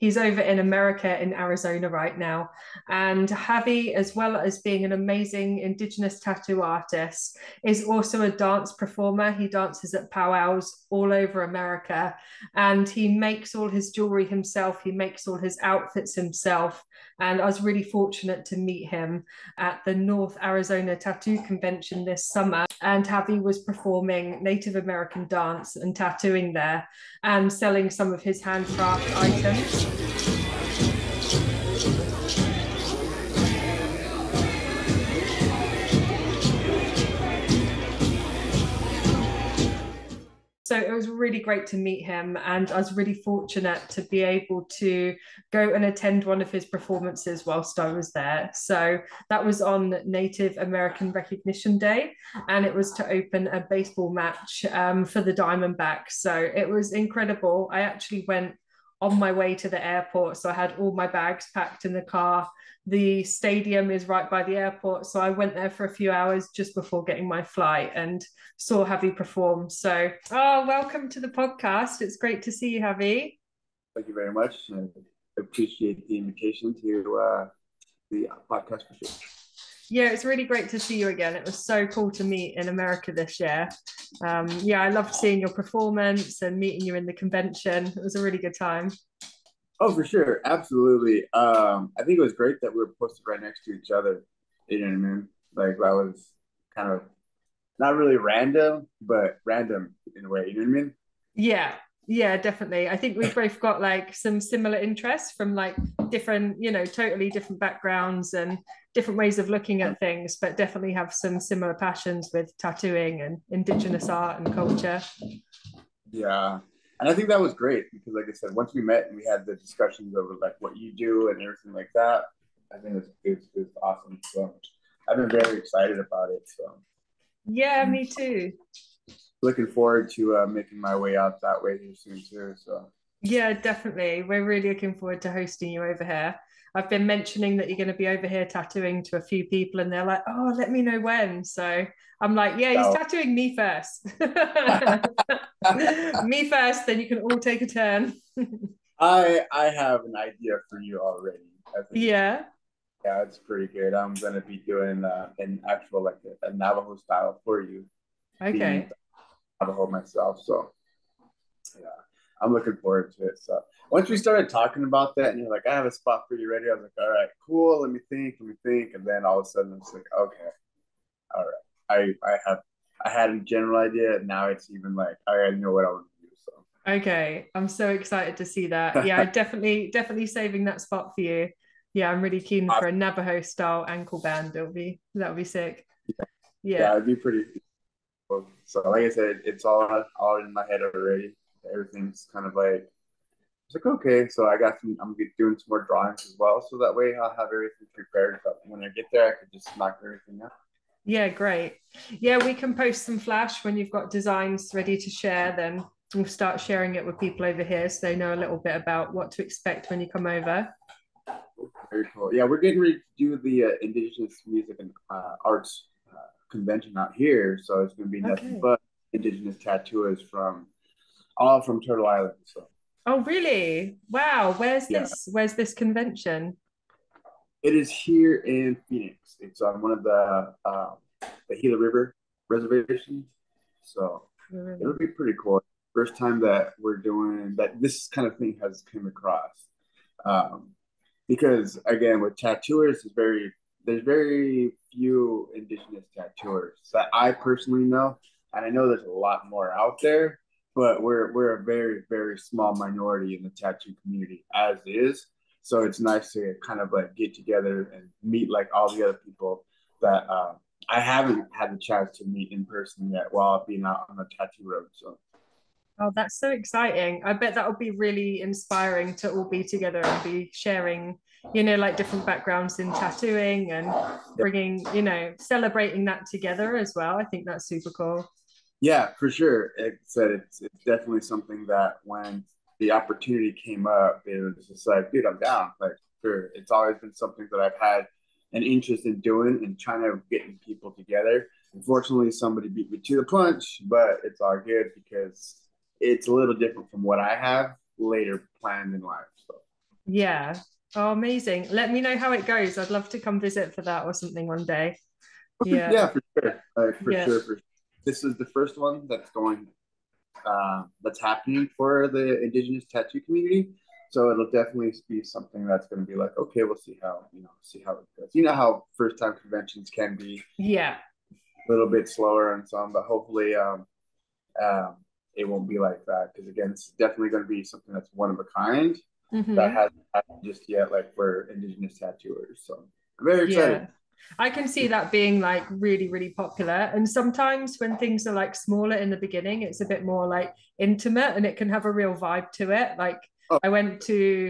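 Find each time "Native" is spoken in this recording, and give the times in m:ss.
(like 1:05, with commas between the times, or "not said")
0:24, 0:50.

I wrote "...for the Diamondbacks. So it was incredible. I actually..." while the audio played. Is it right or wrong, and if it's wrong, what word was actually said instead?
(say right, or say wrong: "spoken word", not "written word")
right.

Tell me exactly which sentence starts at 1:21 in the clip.
It was so cool to meet in America this year.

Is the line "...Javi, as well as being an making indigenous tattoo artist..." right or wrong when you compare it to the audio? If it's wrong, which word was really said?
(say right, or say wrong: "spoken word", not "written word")
wrong: "amazing", not "making".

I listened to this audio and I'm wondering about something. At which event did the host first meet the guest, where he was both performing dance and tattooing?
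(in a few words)
North Arizona Tattoo Convention.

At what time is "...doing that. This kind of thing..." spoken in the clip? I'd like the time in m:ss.
3:56.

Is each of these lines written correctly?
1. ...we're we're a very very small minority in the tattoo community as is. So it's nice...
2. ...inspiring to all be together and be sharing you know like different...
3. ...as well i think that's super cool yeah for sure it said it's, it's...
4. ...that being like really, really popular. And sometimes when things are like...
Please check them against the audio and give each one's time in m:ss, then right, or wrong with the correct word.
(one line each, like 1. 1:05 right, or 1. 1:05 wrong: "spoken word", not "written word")
1. 4:11 right
2. 4:28 right
3. 4:36 right
4. 5:34 right.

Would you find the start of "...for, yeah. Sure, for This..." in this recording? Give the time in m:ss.
5:06.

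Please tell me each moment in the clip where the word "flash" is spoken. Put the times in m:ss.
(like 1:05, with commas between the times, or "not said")
3:23.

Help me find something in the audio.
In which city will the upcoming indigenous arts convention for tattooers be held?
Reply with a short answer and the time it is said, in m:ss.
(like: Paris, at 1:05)
Phoenix, at 3:48.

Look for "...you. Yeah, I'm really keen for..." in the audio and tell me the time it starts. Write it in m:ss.
3:01.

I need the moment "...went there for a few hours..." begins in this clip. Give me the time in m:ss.
1:05.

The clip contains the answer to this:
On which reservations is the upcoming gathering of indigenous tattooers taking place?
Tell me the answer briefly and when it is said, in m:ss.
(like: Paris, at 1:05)
Gila River reservations, at 3:51.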